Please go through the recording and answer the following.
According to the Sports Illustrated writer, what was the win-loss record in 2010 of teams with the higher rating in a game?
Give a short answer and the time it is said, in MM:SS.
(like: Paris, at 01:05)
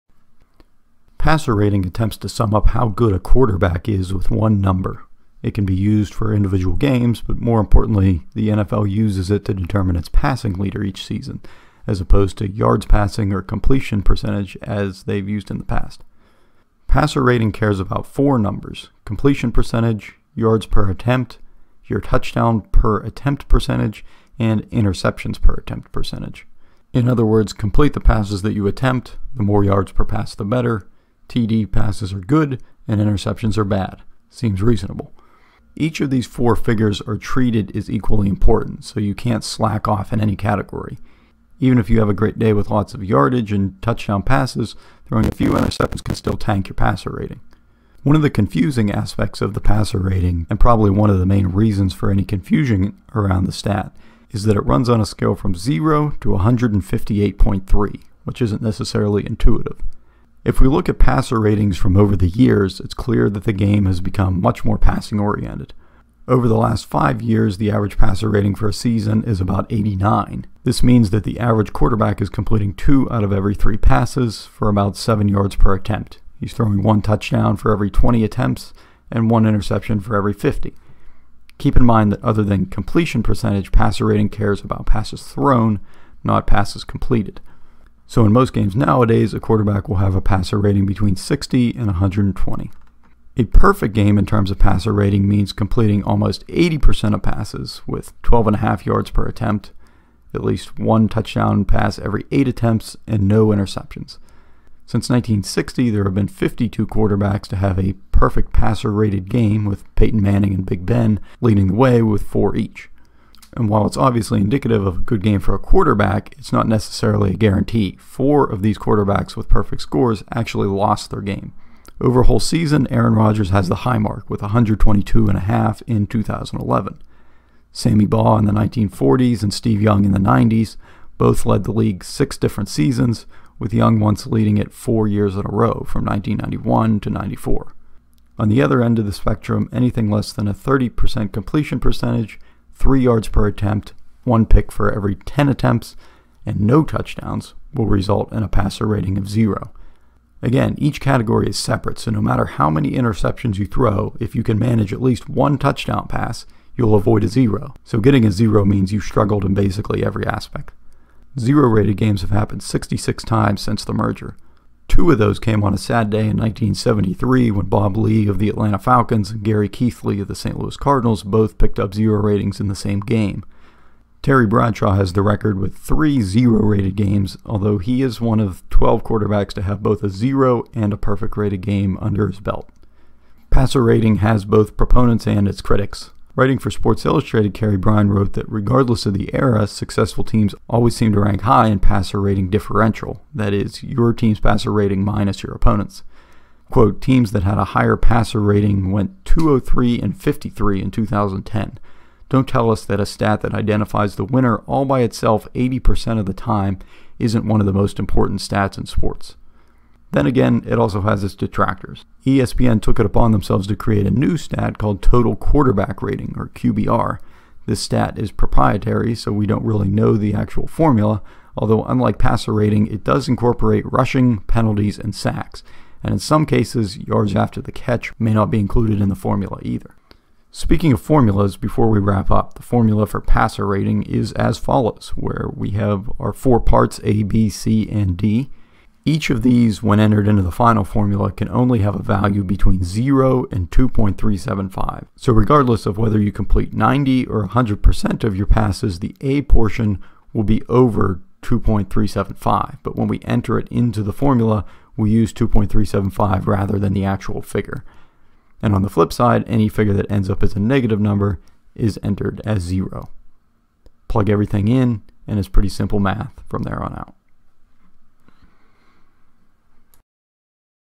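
203 and 53, at 03:19.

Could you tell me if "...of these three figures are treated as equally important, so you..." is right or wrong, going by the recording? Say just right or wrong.
wrong.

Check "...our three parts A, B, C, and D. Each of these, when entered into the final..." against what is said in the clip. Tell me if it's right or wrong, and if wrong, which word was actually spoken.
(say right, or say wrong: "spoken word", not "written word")
wrong: "four", not "three".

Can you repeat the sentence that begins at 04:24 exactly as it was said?
Plug everything in, and it's pretty simple math from there on out.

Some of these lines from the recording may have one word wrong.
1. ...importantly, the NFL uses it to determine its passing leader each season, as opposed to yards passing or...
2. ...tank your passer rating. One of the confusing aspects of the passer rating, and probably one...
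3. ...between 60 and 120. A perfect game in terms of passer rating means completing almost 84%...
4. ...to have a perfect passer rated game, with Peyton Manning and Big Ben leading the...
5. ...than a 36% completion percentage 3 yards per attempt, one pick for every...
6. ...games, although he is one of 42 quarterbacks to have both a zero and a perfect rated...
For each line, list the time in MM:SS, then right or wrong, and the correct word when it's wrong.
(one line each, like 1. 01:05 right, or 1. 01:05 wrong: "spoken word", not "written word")
1. 00:07 right
2. 00:46 right
3. 01:30 wrong: "80", not "84"
4. 01:47 right
5. 02:20 wrong: "30", not "36"
6. 02:56 wrong: "12", not "42".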